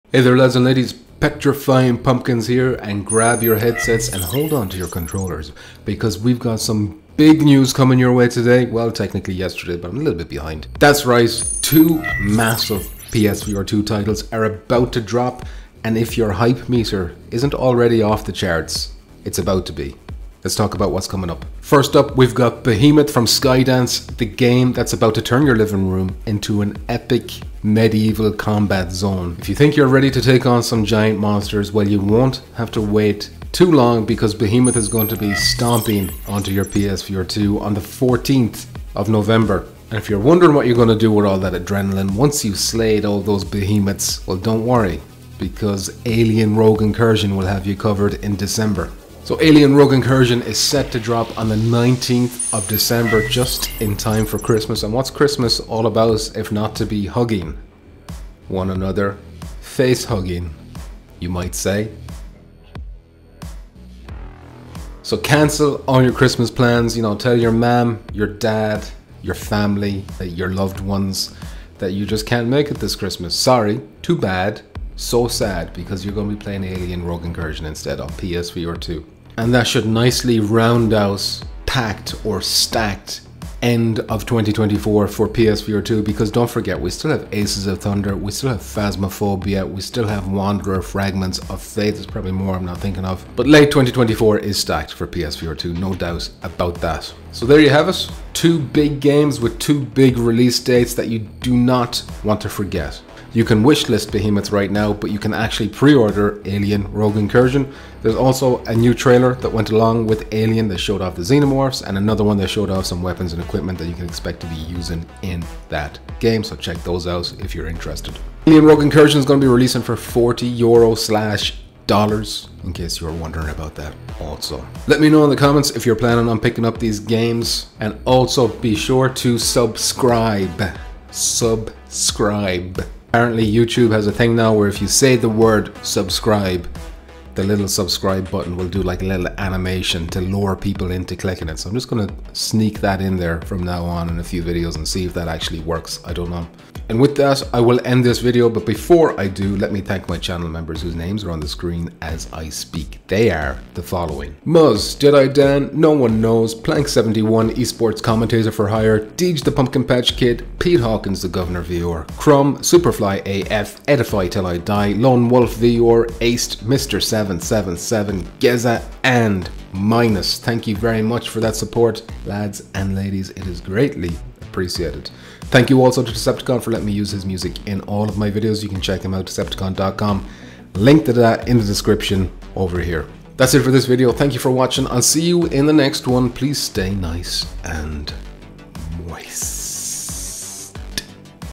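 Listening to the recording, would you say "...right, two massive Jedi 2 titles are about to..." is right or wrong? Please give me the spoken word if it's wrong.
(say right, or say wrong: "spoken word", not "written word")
wrong: "PSVR", not "Jedi".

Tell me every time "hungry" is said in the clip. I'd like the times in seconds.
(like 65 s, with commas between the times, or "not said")
not said.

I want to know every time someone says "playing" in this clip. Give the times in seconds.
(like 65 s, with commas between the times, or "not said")
76 s.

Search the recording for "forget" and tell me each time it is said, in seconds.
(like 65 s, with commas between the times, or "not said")
86 s, 102 s.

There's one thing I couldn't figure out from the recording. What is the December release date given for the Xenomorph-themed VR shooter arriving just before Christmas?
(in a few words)
19th of December.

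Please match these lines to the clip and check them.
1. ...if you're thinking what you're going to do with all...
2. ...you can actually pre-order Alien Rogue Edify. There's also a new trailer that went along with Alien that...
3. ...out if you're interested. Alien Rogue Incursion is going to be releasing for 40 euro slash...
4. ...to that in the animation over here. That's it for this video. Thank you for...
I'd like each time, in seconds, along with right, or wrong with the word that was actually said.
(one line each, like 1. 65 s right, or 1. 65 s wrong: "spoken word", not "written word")
1. 39 s wrong: "wondering", not "thinking"
2. 105 s wrong: "Incursion", not "Edify"
3. 117 s right
4. 181 s wrong: "description", not "animation".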